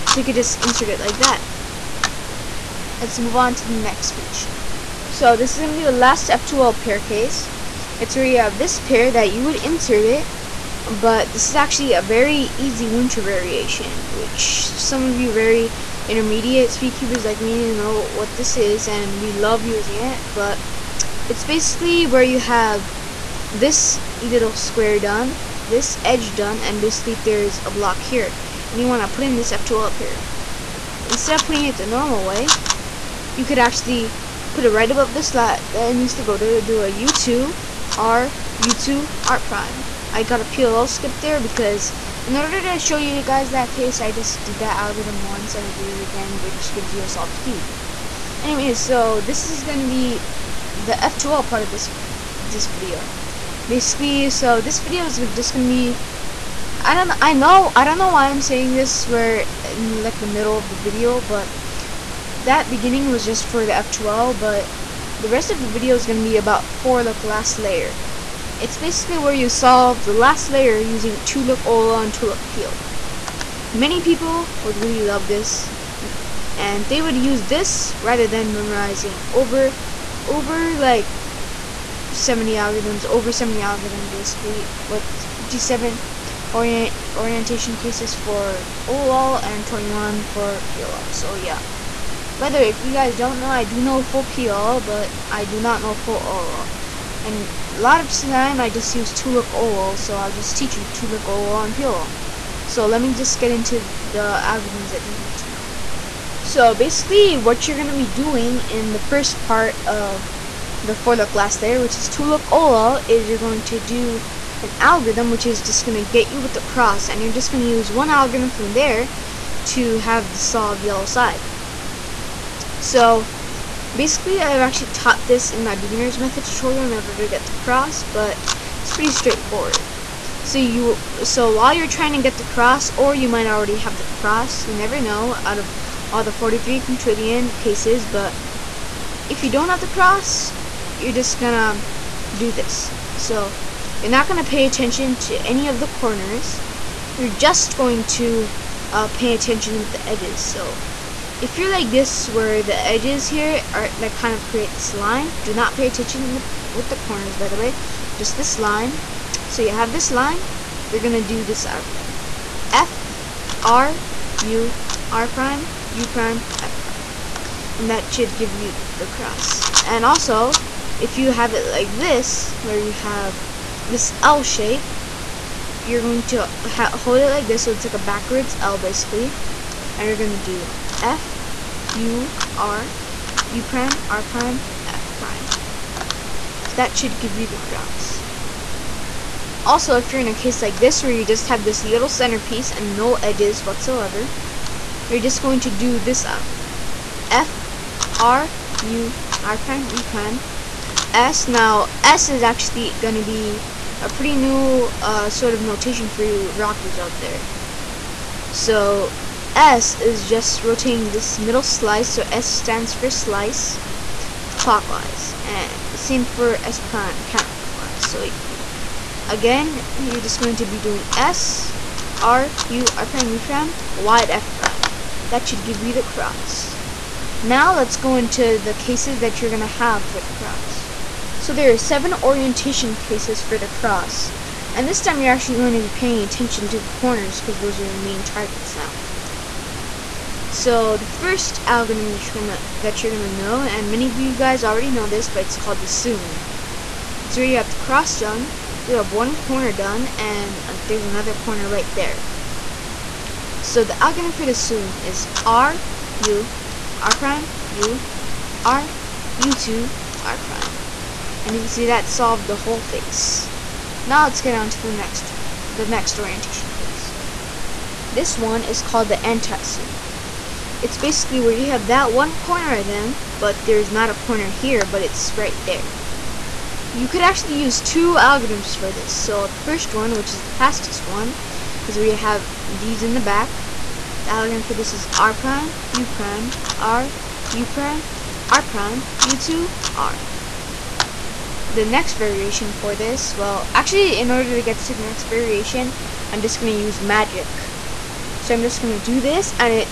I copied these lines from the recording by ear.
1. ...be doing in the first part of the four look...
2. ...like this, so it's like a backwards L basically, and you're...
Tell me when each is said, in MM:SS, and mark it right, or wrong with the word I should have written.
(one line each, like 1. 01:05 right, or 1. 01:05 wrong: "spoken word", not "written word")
1. 01:47 right
2. 02:57 right.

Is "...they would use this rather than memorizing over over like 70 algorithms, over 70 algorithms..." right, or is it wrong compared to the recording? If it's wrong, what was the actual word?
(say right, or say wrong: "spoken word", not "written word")
right.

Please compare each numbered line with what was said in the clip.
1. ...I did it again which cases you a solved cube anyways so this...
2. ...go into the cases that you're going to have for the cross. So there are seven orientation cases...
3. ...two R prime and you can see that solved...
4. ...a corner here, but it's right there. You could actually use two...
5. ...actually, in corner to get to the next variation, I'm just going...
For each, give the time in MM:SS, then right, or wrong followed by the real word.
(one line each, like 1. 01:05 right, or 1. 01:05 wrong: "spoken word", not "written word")
1. 00:45 wrong: "gives", not "cases"
2. 03:47 right
3. 04:19 right
4. 04:34 right
5. 04:53 wrong: "order", not "corner".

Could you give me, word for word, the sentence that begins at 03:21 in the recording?
Now, S is actually going to be a pretty new uh, sort of notation for you rockers out there.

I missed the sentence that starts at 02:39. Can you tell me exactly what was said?
So you have this line, you're gonna do this algorithm.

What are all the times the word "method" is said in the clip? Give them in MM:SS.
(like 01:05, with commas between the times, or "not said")
02:06.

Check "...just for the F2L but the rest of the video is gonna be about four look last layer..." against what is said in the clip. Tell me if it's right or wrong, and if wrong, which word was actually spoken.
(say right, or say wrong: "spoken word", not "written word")
right.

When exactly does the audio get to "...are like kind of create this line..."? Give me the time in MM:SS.
02:33.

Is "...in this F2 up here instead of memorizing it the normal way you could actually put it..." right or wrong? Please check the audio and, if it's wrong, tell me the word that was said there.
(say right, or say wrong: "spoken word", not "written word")
wrong: "putting", not "memorizing".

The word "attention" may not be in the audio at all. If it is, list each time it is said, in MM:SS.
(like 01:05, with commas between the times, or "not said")
02:24, 02:29, 02:35, 03:56.